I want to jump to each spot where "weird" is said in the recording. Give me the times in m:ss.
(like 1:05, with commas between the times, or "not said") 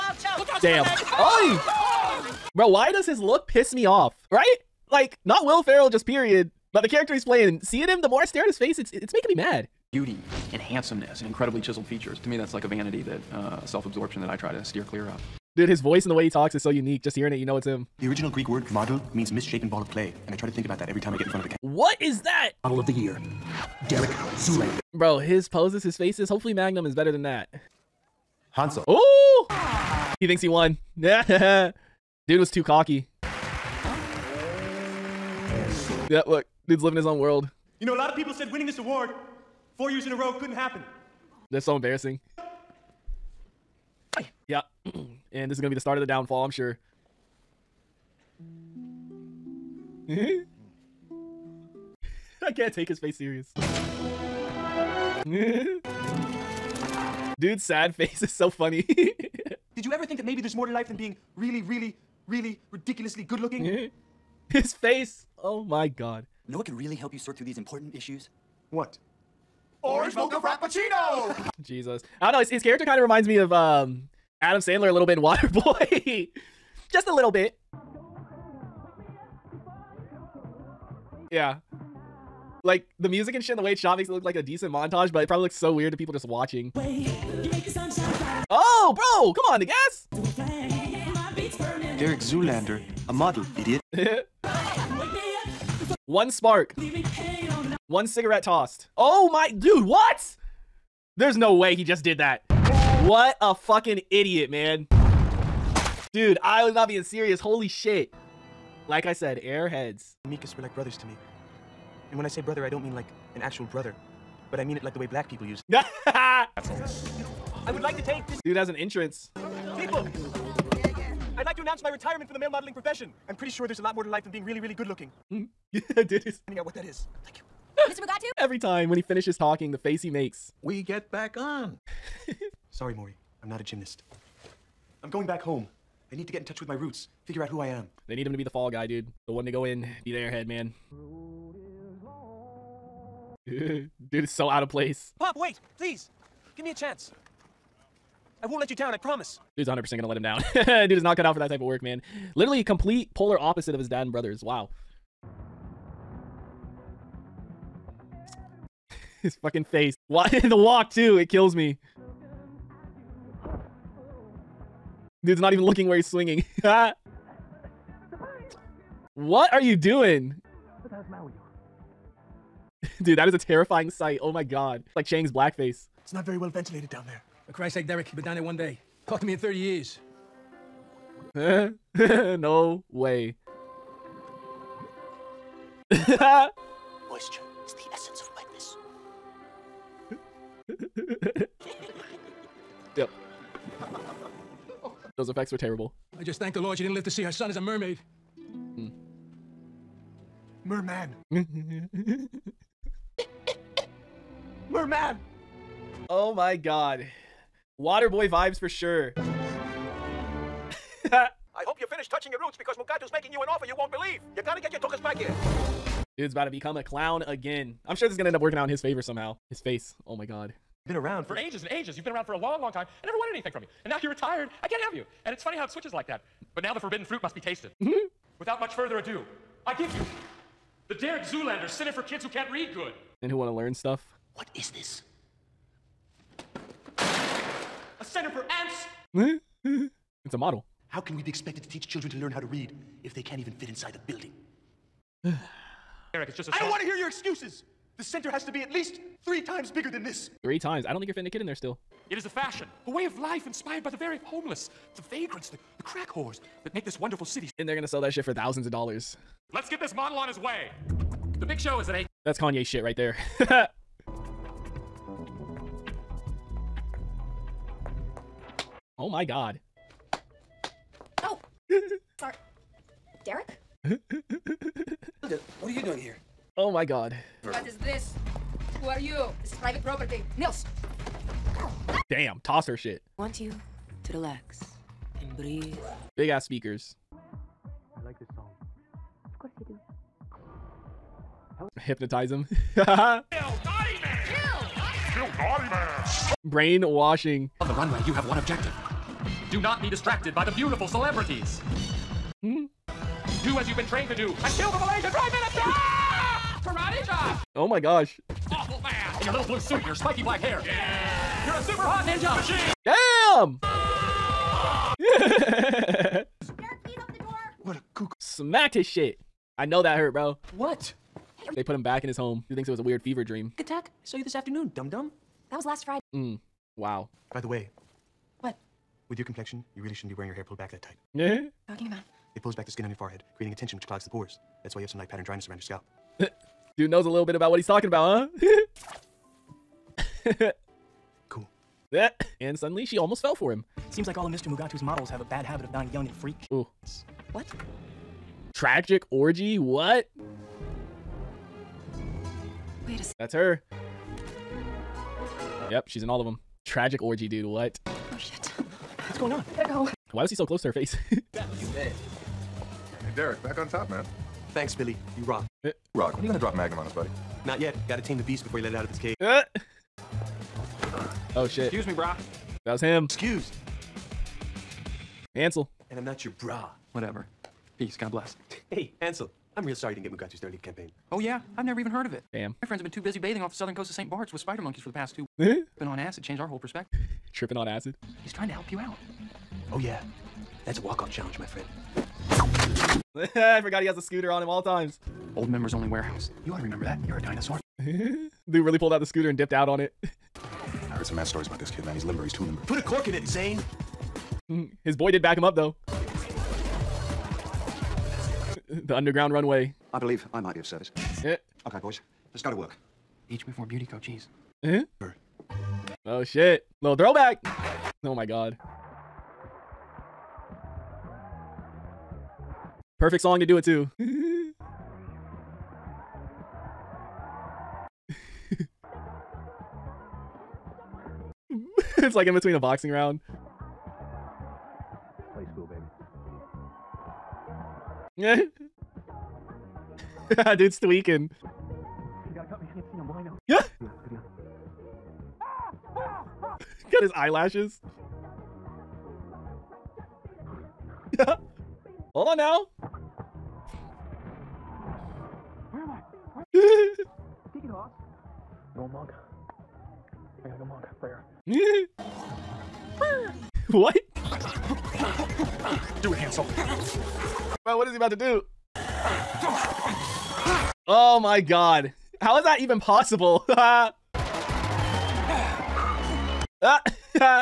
1:25, 5:22.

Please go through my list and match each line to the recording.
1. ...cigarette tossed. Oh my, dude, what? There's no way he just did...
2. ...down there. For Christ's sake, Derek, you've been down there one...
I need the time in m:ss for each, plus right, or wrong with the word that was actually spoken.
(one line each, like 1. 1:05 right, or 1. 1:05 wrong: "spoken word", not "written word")
1. 1:38 right
2. 2:56 right.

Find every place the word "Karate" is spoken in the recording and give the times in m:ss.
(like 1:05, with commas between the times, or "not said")
5:06.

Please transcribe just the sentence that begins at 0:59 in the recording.
Did you ever think that maybe there's more to life than being really, really, really ridiculously good looking?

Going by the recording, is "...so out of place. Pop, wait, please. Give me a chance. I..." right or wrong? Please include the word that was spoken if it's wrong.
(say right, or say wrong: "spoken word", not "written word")
right.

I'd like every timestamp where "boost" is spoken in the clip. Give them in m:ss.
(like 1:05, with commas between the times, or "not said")
not said.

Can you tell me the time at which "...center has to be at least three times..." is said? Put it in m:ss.
4:08.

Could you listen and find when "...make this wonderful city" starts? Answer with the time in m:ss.
4:16.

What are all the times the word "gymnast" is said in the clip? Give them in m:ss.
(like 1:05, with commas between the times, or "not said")
2:13.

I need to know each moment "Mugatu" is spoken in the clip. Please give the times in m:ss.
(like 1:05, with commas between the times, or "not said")
2:07, 3:32, 5:44, 6:20.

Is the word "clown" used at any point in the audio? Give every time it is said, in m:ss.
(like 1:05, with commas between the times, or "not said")
3:36.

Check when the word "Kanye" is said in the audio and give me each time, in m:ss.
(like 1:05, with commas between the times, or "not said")
4:22.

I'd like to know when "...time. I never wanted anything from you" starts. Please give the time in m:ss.
3:42.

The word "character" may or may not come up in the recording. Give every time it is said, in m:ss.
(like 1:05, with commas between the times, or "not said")
0:06, 1:12.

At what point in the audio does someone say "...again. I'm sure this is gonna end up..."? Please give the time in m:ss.
3:37.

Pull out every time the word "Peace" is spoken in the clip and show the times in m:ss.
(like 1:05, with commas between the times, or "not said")
6:17.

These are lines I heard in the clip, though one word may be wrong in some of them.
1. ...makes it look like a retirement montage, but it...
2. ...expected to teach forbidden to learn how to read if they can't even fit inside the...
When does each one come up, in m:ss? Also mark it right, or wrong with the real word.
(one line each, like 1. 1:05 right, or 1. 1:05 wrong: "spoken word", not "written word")
1. 1:23 wrong: "decent", not "retirement"
2. 4:01 wrong: "children", not "forbidden".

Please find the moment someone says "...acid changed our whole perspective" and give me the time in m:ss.
6:25.